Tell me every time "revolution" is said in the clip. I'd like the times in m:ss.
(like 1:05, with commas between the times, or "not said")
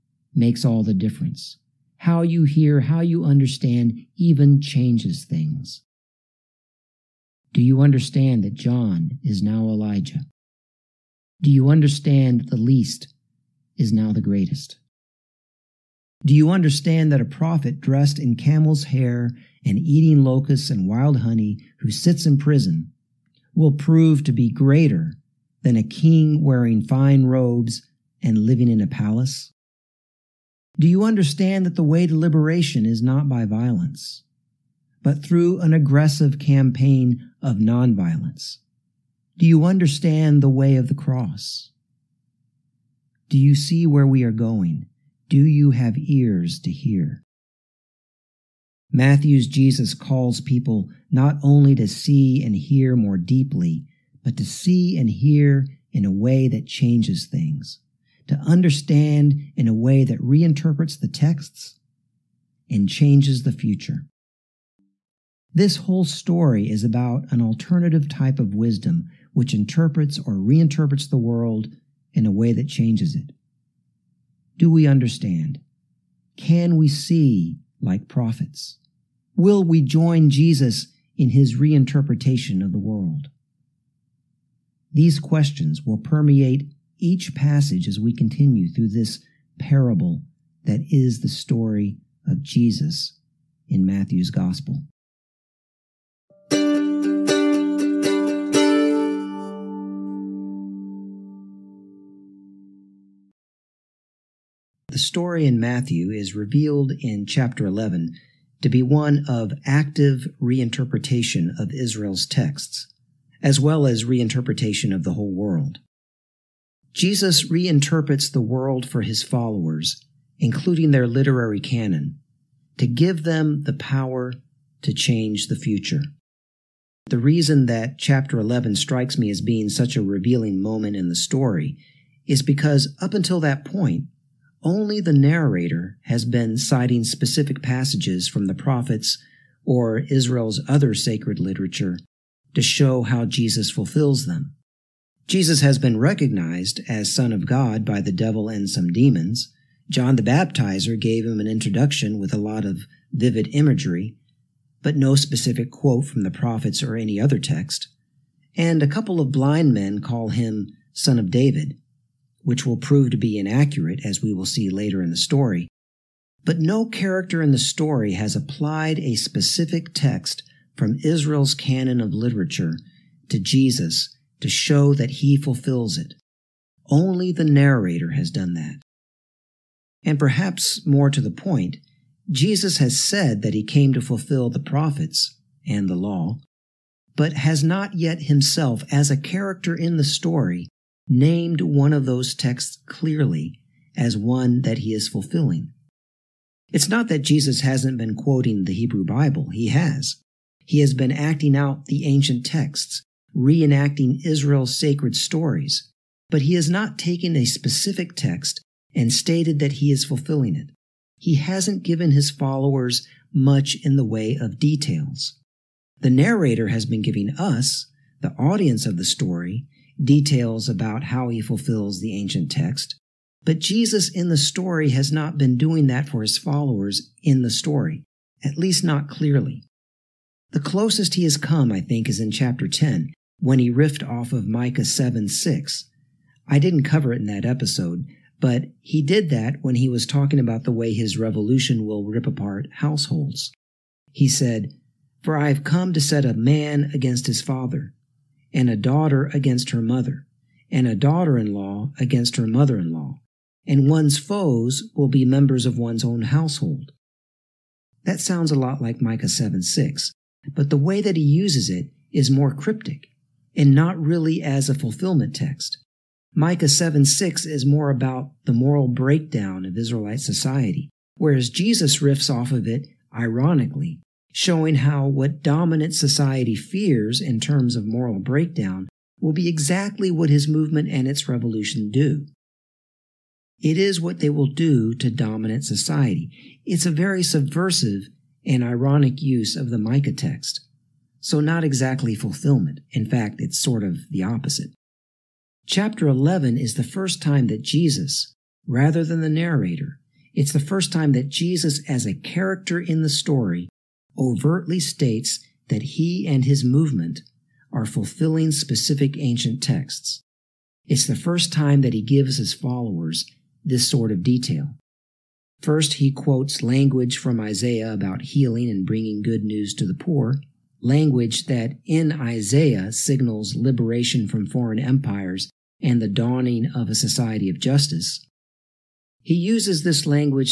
4:01, 4:41.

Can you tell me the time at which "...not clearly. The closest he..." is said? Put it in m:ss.
3:48.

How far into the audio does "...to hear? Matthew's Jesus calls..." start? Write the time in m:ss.
0:46.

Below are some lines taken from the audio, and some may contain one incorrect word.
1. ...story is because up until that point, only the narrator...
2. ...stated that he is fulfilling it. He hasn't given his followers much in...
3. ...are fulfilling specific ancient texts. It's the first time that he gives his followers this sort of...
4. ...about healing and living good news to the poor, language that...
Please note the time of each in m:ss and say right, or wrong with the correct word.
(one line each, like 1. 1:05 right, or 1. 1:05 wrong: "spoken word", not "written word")
1. 2:11 right
2. 3:29 right
3. 5:07 right
4. 5:17 wrong: "bringing", not "living".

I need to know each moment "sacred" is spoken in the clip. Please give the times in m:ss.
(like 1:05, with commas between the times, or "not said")
2:20, 3:24.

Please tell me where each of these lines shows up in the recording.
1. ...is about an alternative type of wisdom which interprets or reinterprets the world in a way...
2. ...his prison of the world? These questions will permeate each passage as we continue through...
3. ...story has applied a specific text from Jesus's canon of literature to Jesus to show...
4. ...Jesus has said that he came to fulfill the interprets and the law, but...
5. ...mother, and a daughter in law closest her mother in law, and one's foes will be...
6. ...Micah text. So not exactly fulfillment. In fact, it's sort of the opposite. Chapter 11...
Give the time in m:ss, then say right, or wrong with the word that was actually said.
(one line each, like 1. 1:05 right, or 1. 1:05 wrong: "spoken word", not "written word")
1. 1:06 right
2. 1:21 wrong: "reinterpretation", not "prison"
3. 2:47 wrong: "Israel", not "Jesus"
4. 3:02 wrong: "prophets", not "interprets"
5. 4:09 wrong: "against", not "closest"
6. 4:49 right.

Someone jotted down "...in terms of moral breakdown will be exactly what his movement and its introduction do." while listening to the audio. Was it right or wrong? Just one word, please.
wrong.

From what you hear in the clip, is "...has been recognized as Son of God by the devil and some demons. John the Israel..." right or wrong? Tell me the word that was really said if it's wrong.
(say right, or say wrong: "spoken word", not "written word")
wrong: "Baptizer", not "Israel".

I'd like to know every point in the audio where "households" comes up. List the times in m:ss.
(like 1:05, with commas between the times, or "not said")
4:02, 4:16.